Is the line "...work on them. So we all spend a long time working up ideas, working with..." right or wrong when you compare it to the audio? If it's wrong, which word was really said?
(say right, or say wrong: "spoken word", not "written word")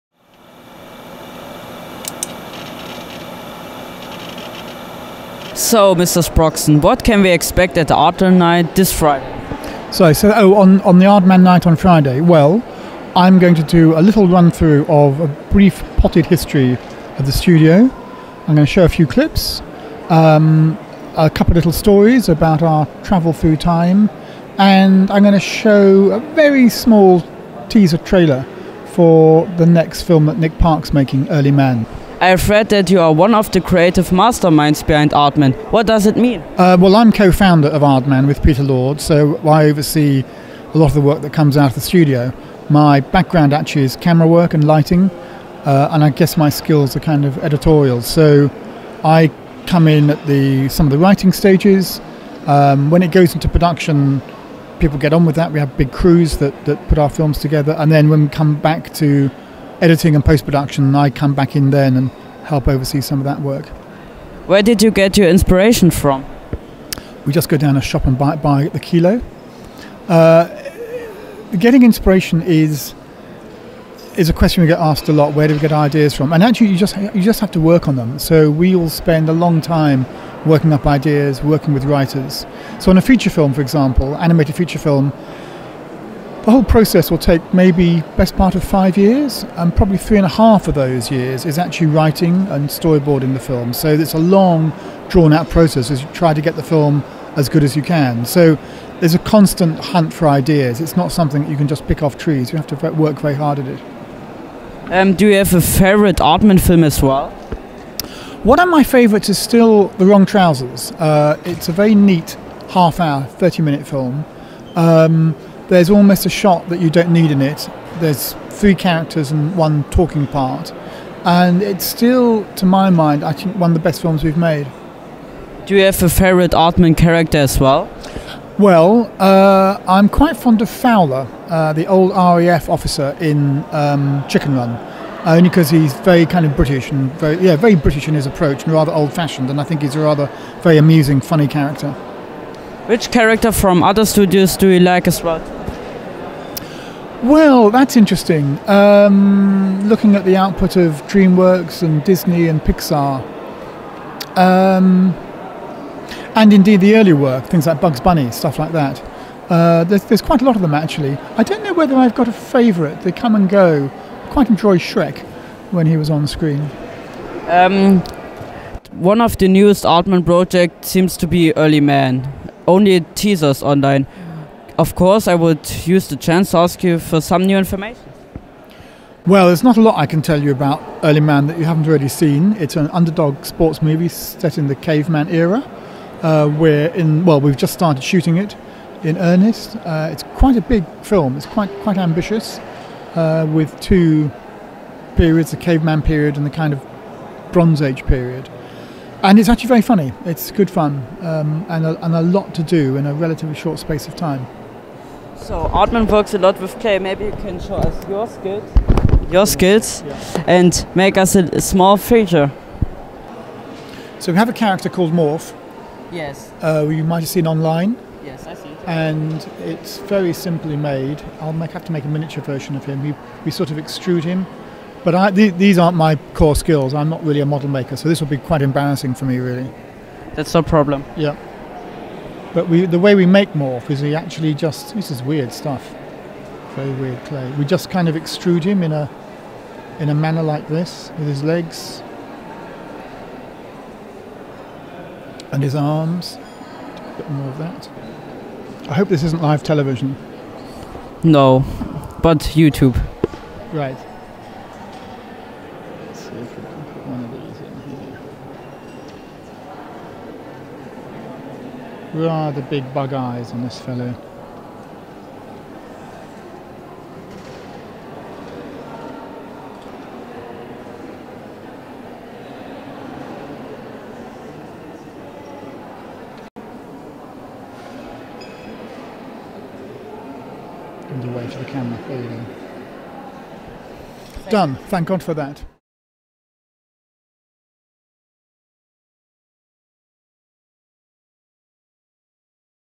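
right.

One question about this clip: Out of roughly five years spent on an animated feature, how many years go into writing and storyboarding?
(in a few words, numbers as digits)
3.5.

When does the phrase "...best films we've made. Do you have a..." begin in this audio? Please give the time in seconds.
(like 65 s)
123 s.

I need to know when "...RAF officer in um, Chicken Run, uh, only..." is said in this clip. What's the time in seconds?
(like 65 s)
132 s.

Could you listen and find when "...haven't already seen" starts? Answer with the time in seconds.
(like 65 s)
181 s.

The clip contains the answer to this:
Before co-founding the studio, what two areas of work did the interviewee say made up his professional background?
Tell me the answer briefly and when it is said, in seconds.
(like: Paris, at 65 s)
Camera work and lighting, at 43 s.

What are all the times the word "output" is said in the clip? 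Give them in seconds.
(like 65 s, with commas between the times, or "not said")
150 s.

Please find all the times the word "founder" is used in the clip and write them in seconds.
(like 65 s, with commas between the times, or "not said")
37 s.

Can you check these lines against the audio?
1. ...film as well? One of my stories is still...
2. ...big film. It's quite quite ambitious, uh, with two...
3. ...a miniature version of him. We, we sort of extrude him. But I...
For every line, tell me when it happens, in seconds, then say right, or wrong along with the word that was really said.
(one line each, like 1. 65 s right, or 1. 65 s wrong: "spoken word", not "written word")
1. 106 s wrong: "favorites", not "stories"
2. 190 s right
3. 222 s right.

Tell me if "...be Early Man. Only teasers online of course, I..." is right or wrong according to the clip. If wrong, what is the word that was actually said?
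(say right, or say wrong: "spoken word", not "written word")
right.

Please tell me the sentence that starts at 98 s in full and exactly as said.
So there's a constant hunt for ideas.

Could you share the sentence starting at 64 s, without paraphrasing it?
Where did you get your inspiration from?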